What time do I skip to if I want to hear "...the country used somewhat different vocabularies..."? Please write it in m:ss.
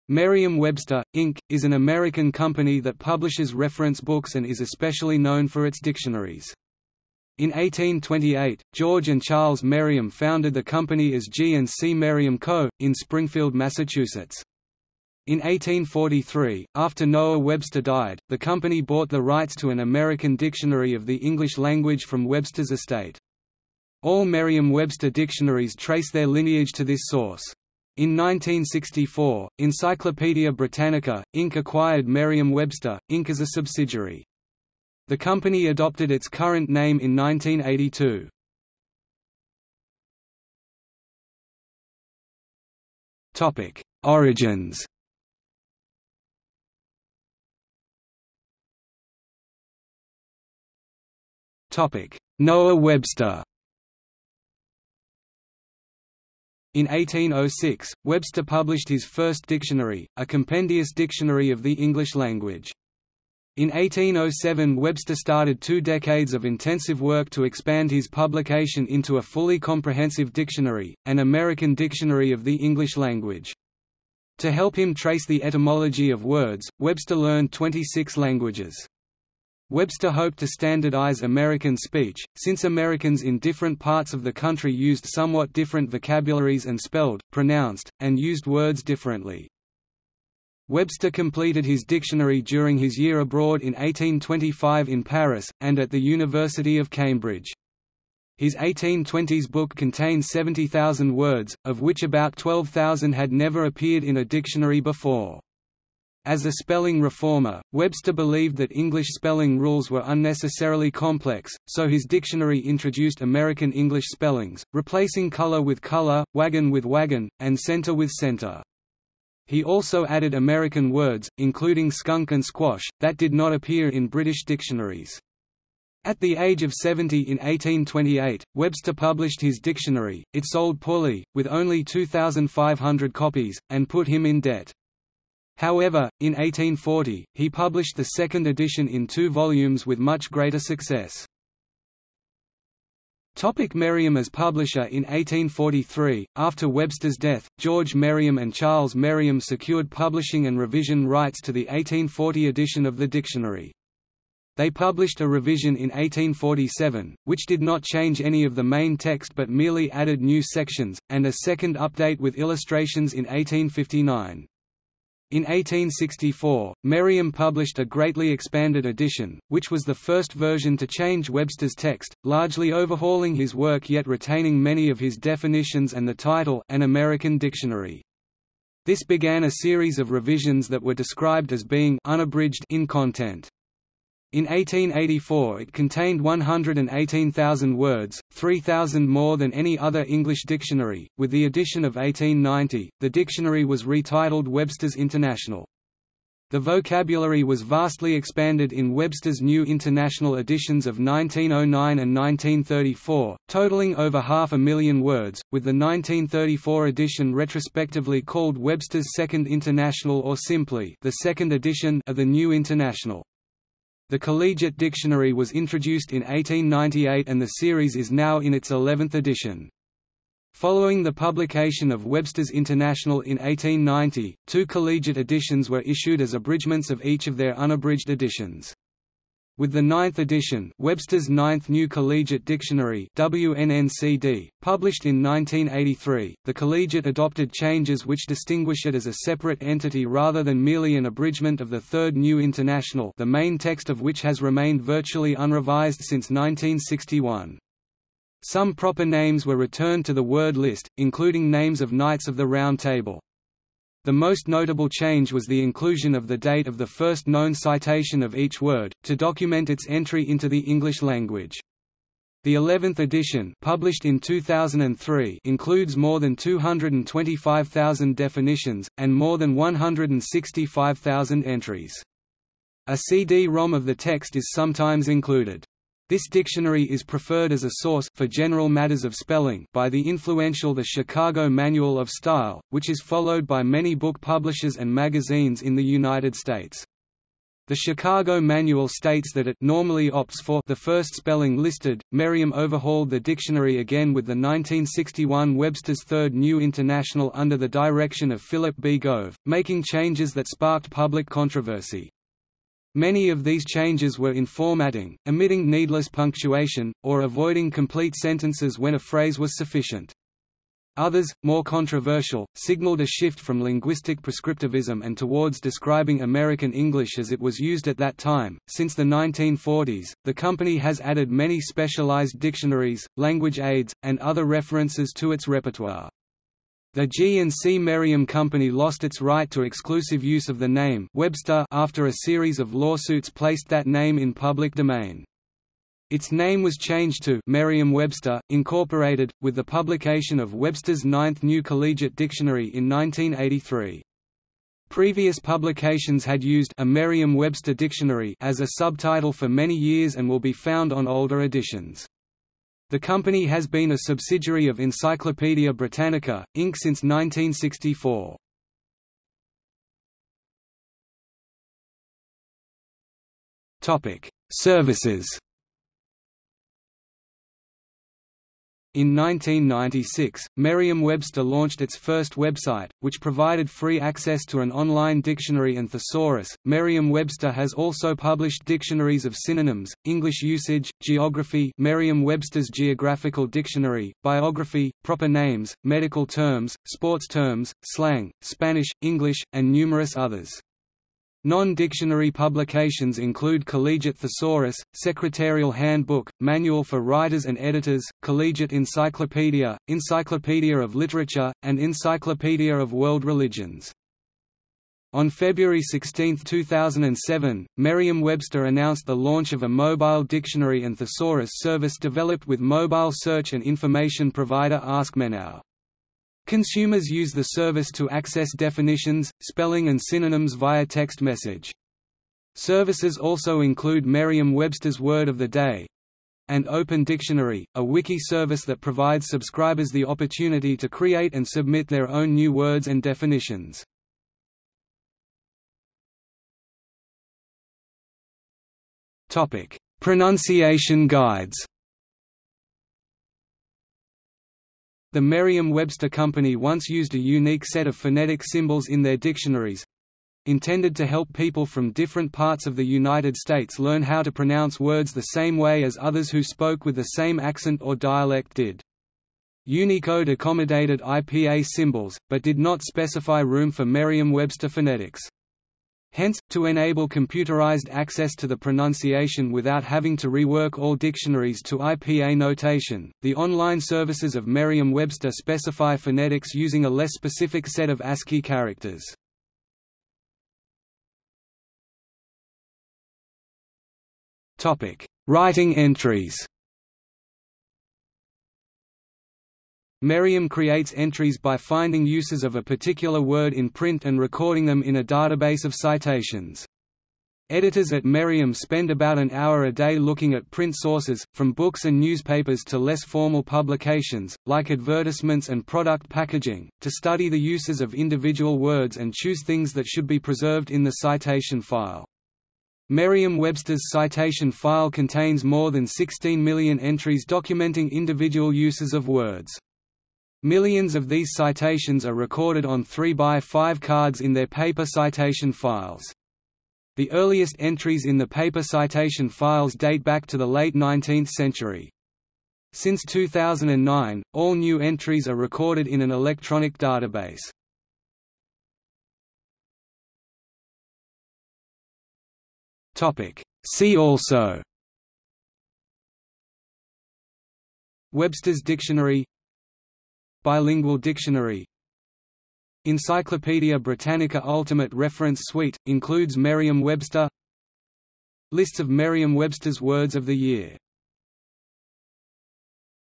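1:24.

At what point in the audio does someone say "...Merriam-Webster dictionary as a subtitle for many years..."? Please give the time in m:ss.
5:46.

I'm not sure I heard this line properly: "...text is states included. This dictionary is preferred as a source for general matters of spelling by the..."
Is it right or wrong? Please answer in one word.
wrong.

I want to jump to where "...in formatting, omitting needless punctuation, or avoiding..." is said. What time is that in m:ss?
5:04.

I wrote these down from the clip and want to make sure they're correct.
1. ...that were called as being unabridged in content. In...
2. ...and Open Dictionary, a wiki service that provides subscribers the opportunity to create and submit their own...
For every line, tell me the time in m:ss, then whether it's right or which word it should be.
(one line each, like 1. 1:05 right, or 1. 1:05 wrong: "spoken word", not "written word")
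1. 3:00 wrong: "described", not "called"
2. 7:06 right.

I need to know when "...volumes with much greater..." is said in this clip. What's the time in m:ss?
2:19.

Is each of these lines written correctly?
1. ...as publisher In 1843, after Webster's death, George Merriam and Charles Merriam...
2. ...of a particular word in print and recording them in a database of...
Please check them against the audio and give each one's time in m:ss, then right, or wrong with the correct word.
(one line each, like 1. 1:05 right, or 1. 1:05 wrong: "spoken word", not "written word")
1. 2:24 right
2. 8:12 right.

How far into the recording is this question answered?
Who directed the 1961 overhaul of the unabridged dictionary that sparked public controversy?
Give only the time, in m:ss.
4:58.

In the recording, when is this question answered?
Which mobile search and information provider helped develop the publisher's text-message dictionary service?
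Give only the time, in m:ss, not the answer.
6:54.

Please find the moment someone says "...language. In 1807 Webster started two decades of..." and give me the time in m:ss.
1:02.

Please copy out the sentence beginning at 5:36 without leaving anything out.
Its name was changed to Merriam-Webster, Incorporated, with the publication of Webster's Ninth New Collegiate Dictionary in 1983.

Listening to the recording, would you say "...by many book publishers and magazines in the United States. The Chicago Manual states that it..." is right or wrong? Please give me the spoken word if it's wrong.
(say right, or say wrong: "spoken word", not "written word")
right.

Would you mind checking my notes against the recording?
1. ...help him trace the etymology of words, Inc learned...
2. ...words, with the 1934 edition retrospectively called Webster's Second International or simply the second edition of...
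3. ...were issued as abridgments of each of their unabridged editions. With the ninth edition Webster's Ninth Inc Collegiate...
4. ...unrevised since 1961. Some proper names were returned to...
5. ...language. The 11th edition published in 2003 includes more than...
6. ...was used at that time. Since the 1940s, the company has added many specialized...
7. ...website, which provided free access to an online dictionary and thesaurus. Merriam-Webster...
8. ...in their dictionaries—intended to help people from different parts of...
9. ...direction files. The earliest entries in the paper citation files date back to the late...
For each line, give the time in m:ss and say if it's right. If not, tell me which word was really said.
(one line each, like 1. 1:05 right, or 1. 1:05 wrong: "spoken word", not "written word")
1. 1:14 wrong: "Webster", not "Inc"
2. 3:25 right
3. 3:45 wrong: "New", not "Inc"
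4. 4:05 right
5. 4:21 right
6. 5:17 right
7. 6:12 right
8. 7:28 right
9. 8:44 wrong: "citation", not "direction".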